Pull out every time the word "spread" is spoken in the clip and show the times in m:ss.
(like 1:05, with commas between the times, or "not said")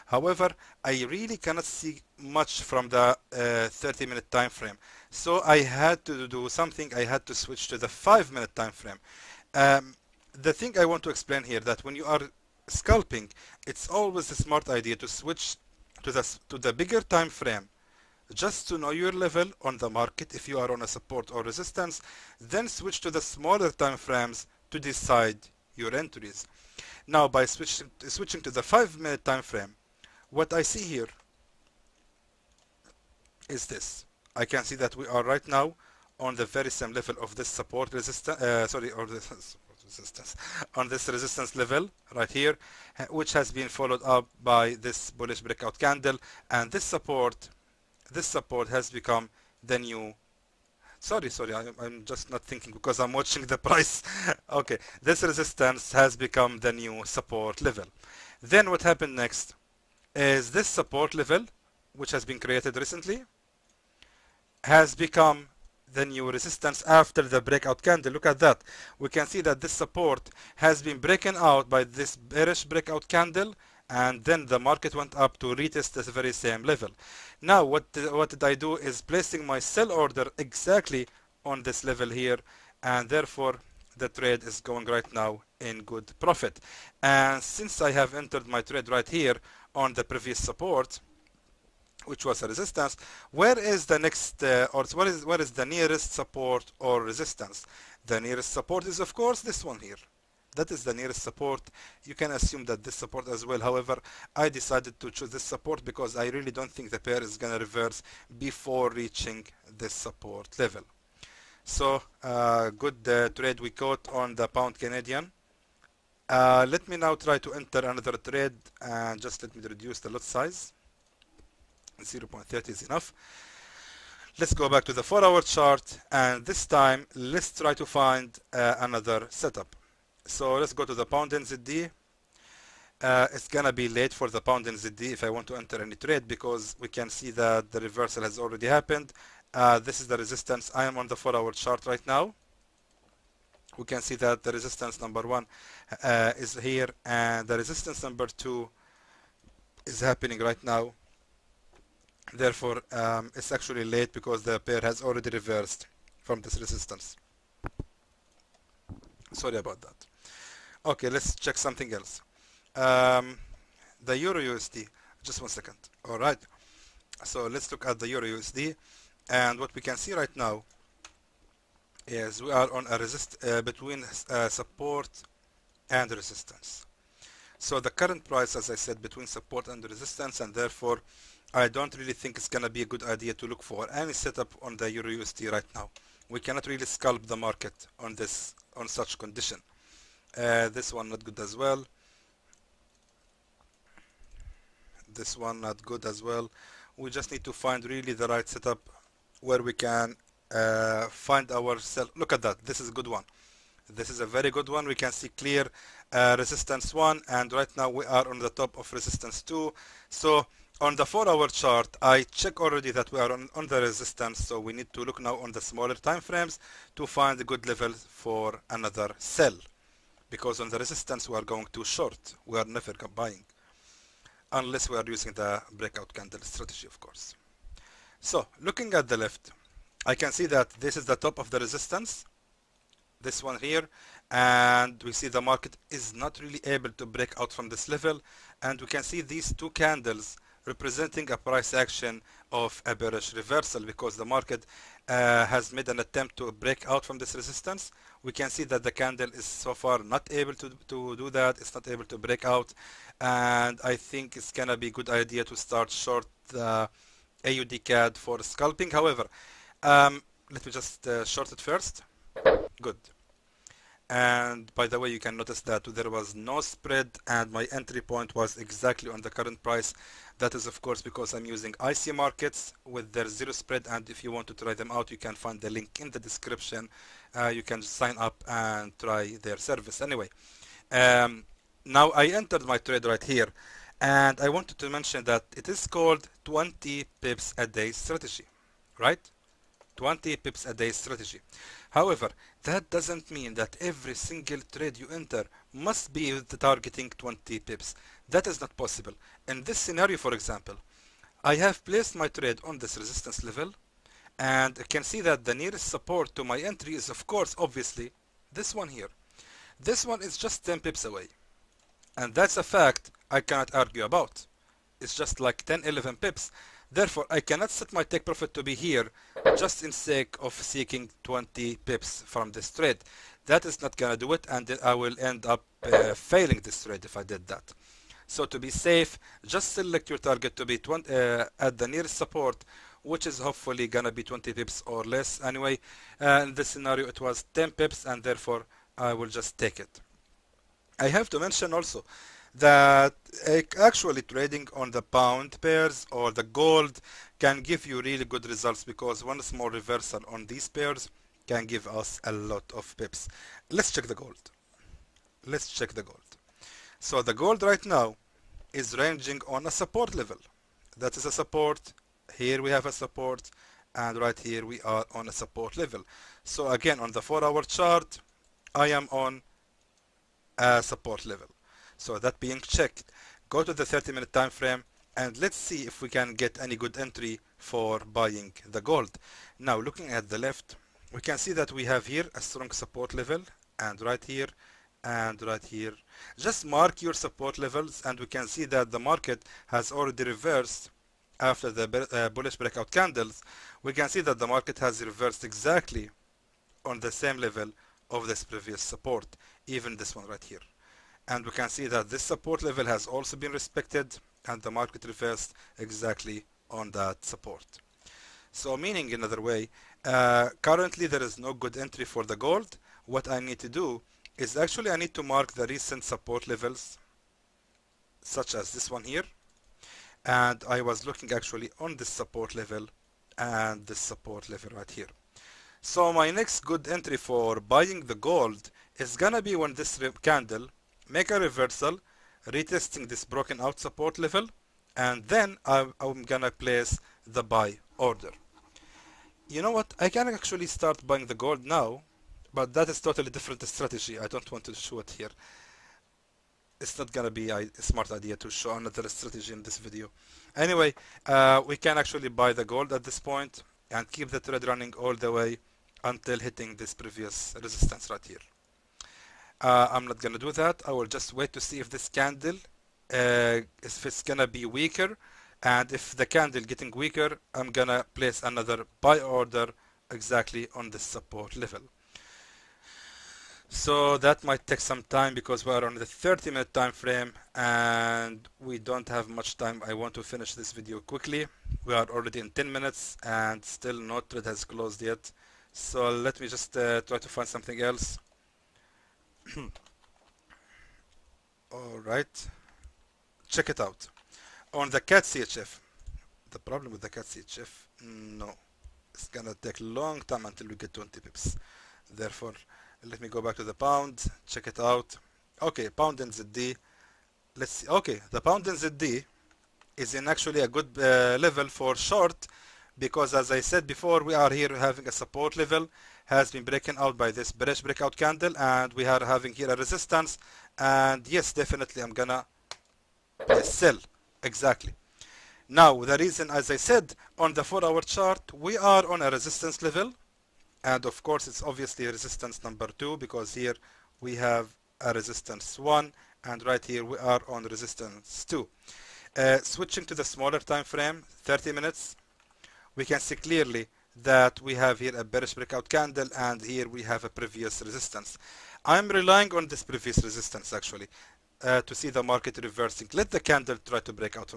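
4:26, 4:33.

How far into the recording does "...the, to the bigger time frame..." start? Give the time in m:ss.
0:16.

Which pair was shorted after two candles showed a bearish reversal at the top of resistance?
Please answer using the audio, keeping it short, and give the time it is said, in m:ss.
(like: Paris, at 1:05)
AUD CAD, at 4:17.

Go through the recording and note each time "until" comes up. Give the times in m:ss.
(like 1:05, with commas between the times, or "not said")
7:36, 8:20.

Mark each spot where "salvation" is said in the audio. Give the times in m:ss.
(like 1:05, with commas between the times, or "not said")
not said.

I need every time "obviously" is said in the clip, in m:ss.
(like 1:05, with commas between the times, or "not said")
5:07, 8:51.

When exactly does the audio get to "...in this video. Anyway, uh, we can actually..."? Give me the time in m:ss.
7:29.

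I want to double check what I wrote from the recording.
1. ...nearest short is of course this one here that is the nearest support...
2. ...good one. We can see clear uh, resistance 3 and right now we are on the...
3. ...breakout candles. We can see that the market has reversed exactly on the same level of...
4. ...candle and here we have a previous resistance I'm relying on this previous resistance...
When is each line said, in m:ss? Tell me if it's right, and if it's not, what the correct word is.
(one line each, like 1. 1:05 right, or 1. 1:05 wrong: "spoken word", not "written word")
1. 1:38 wrong: "support", not "short"
2. 3:24 wrong: "1", not "3"
3. 6:32 right
4. 9:05 right.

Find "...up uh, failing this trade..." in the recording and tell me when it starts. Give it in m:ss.
5:25.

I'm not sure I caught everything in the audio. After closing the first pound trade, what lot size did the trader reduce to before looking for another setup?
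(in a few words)
0.30.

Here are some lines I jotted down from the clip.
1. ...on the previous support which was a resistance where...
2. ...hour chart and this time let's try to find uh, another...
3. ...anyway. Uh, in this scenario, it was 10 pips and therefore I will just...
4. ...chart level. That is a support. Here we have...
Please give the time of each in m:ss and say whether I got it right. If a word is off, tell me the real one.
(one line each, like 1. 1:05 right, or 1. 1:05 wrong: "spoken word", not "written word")
1. 1:29 right
2. 2:05 right
3. 5:35 right
4. 5:59 wrong: "support", not "chart".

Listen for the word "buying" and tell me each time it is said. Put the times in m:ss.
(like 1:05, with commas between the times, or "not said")
3:43, 6:17, 7:07, 7:21.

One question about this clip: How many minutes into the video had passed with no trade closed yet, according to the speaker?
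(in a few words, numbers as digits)
10.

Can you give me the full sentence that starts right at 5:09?
This one is just 10 pips away and that's a fact I cannot argue about.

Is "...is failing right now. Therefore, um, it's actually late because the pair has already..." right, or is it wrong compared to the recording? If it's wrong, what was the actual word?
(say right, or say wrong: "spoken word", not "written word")
wrong: "happening", not "failing".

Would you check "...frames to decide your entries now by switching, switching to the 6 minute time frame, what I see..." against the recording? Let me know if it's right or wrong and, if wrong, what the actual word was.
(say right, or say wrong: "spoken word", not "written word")
wrong: "5", not "6".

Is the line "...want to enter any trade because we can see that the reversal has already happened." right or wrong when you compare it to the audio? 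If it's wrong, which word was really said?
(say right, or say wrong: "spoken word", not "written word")
right.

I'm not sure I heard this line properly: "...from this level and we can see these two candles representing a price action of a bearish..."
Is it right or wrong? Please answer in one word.
right.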